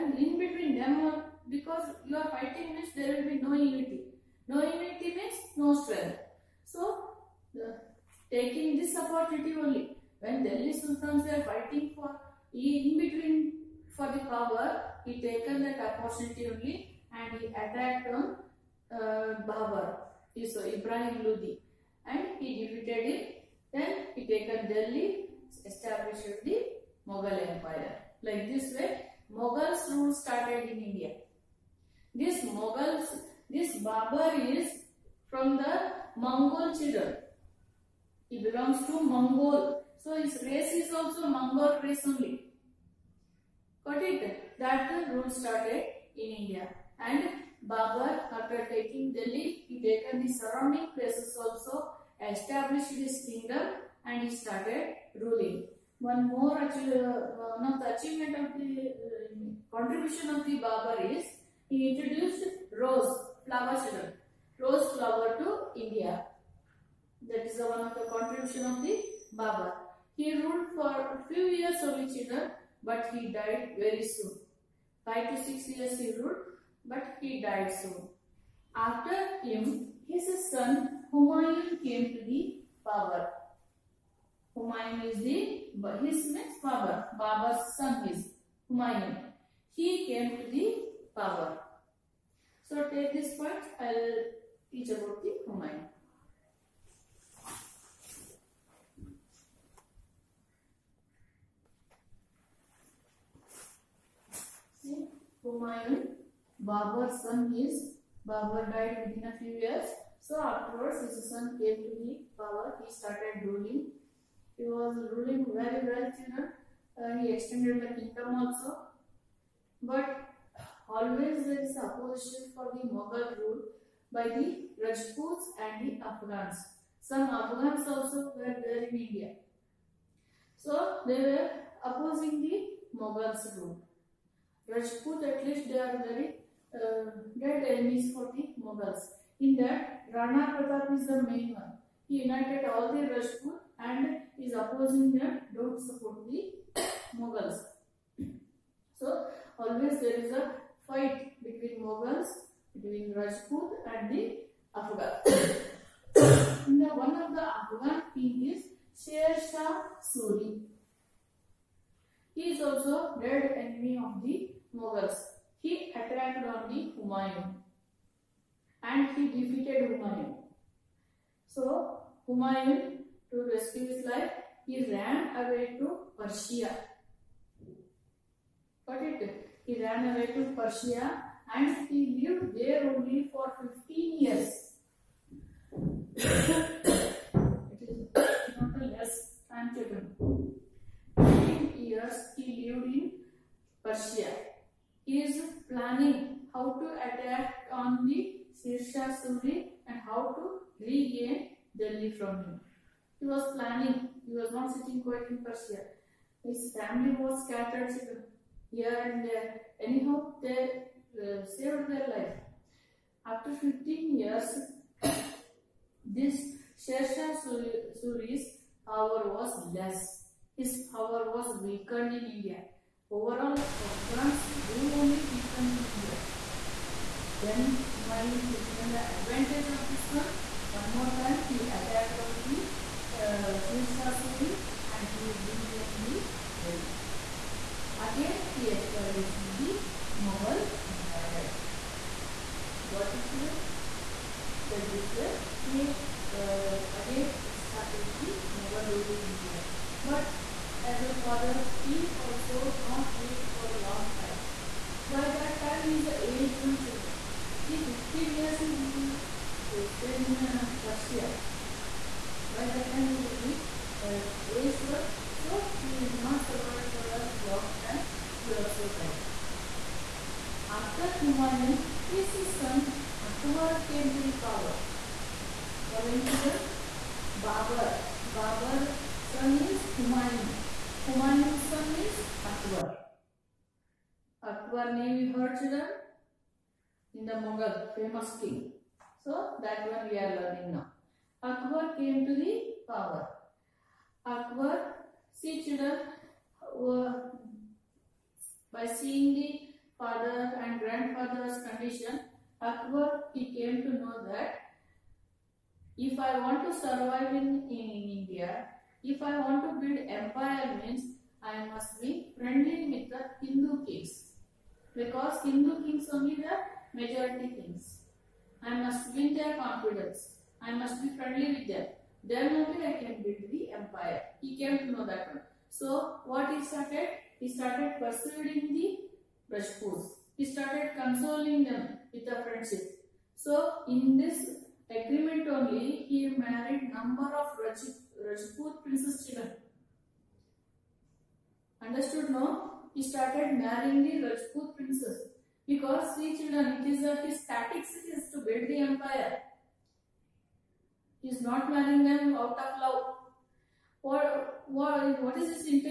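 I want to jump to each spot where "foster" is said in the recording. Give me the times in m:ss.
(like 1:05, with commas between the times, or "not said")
not said.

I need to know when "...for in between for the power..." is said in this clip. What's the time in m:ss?
0:11.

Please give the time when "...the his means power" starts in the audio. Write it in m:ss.
1:25.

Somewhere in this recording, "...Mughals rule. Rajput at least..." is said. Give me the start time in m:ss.
2:12.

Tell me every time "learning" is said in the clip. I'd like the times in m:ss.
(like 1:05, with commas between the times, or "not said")
4:50.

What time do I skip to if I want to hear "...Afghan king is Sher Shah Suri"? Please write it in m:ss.
2:37.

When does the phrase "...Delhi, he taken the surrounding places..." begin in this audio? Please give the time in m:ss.
0:49.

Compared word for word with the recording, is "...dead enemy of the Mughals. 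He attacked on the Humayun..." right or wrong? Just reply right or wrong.
right.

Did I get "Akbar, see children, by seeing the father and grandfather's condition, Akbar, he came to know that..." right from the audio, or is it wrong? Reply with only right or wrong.
right.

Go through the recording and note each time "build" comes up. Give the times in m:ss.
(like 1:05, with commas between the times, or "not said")
5:09, 5:23, 5:48.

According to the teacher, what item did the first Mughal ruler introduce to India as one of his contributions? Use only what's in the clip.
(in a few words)
Rose flower syrup.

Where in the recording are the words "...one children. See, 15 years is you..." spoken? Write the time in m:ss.
4:16.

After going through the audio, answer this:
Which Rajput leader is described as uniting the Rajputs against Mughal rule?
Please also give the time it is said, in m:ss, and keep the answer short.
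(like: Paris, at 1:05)
Rana Pratap, at 2:20.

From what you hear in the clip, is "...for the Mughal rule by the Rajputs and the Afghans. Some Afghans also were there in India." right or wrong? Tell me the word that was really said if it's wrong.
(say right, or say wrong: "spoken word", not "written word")
right.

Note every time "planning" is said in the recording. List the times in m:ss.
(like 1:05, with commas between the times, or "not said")
3:15, 3:23.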